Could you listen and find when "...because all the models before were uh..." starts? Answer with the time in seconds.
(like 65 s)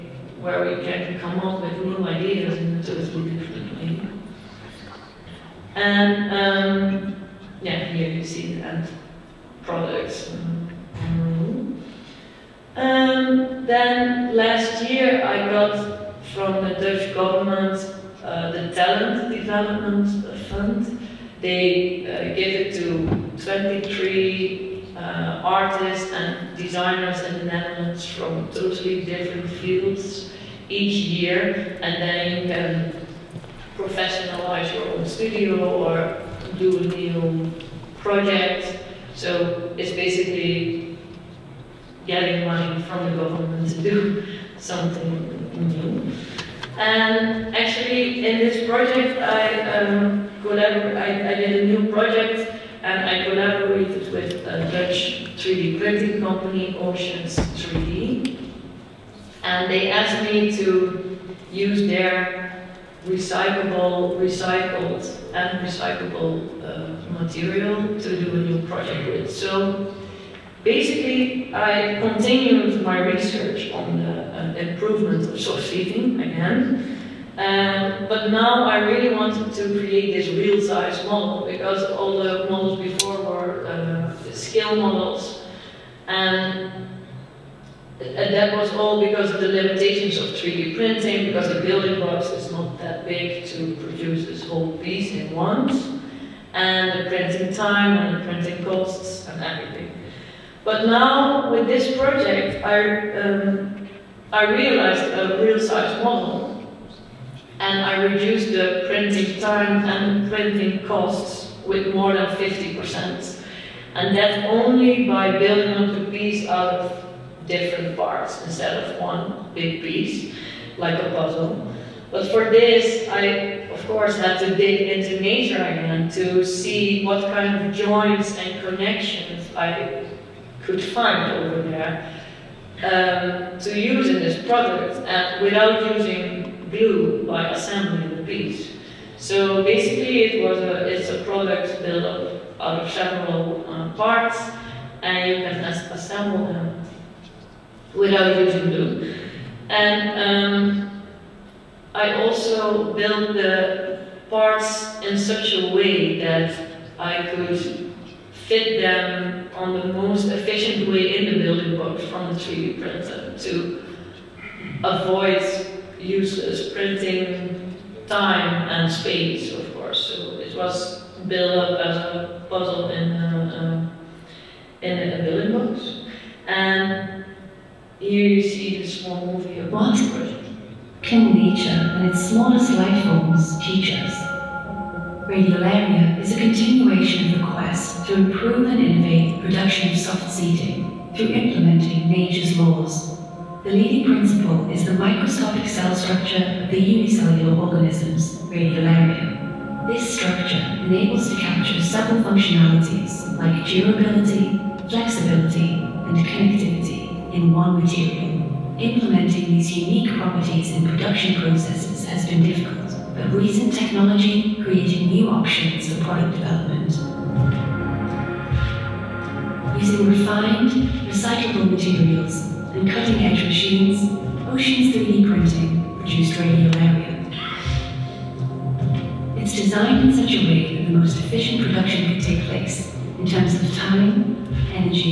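81 s.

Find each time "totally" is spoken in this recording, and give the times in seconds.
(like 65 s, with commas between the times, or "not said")
2 s, 28 s.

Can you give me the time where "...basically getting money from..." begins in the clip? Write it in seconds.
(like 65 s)
39 s.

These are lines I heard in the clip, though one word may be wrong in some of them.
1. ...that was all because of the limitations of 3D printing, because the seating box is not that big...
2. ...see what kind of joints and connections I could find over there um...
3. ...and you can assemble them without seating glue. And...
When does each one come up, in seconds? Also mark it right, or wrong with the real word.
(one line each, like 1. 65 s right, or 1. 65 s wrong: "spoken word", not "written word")
1. 88 s wrong: "building", not "seating"
2. 126 s right
3. 145 s wrong: "using", not "seating".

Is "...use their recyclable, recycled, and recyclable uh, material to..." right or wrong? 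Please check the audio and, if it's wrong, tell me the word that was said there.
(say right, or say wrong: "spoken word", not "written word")
right.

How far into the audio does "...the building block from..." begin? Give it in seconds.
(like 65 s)
161 s.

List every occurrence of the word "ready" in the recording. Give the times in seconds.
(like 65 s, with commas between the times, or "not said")
not said.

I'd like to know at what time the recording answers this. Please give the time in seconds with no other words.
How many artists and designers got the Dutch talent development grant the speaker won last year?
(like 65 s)
23 s.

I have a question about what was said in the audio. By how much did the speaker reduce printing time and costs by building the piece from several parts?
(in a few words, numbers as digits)
More than 50%.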